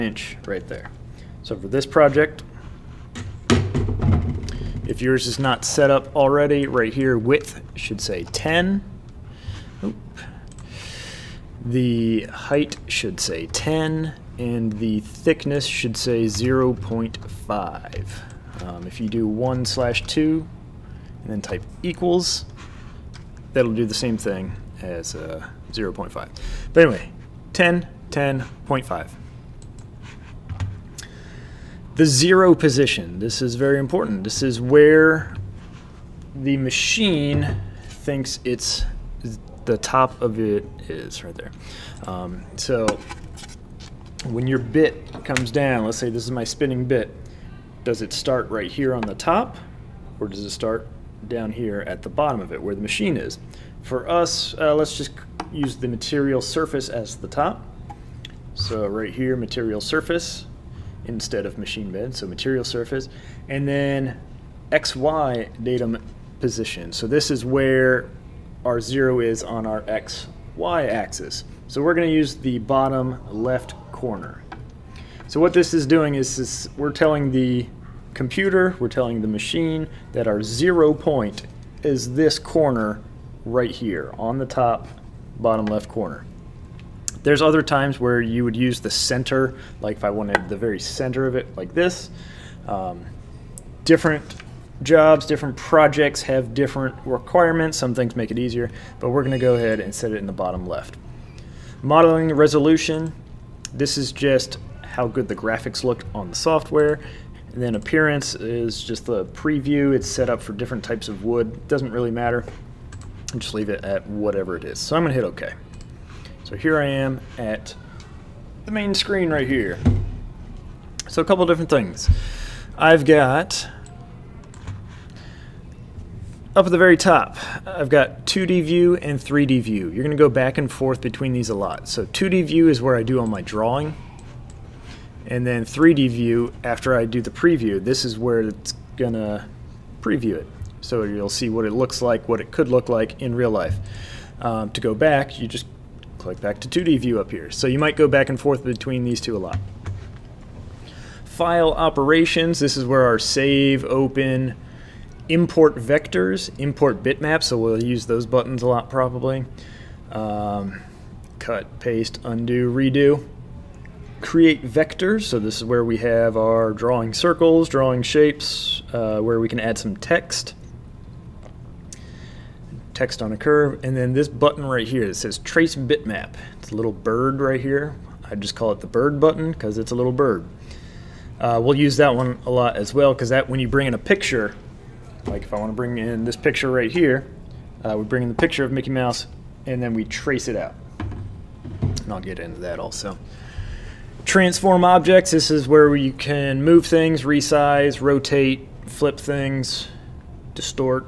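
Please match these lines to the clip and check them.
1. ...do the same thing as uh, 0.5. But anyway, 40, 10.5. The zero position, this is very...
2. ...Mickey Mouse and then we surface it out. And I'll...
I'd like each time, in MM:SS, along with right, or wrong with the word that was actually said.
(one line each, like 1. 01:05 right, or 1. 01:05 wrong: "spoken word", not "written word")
1. 00:23 wrong: "10", not "40"
2. 03:08 wrong: "trace", not "surface".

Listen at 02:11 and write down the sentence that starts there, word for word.
So 2D view is where I do all my drawing.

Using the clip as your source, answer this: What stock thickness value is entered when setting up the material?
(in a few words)
0.5.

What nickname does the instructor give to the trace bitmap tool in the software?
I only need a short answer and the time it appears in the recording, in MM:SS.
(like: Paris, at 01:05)
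The bird button, at 02:58.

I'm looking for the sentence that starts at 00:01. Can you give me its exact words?
So for this project, if yours is not set up already, right here, width should say 10.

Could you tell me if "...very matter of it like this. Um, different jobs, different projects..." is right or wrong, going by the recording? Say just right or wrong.
wrong.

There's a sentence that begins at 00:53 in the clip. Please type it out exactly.
For us, uh, let's just use the material surface as the top.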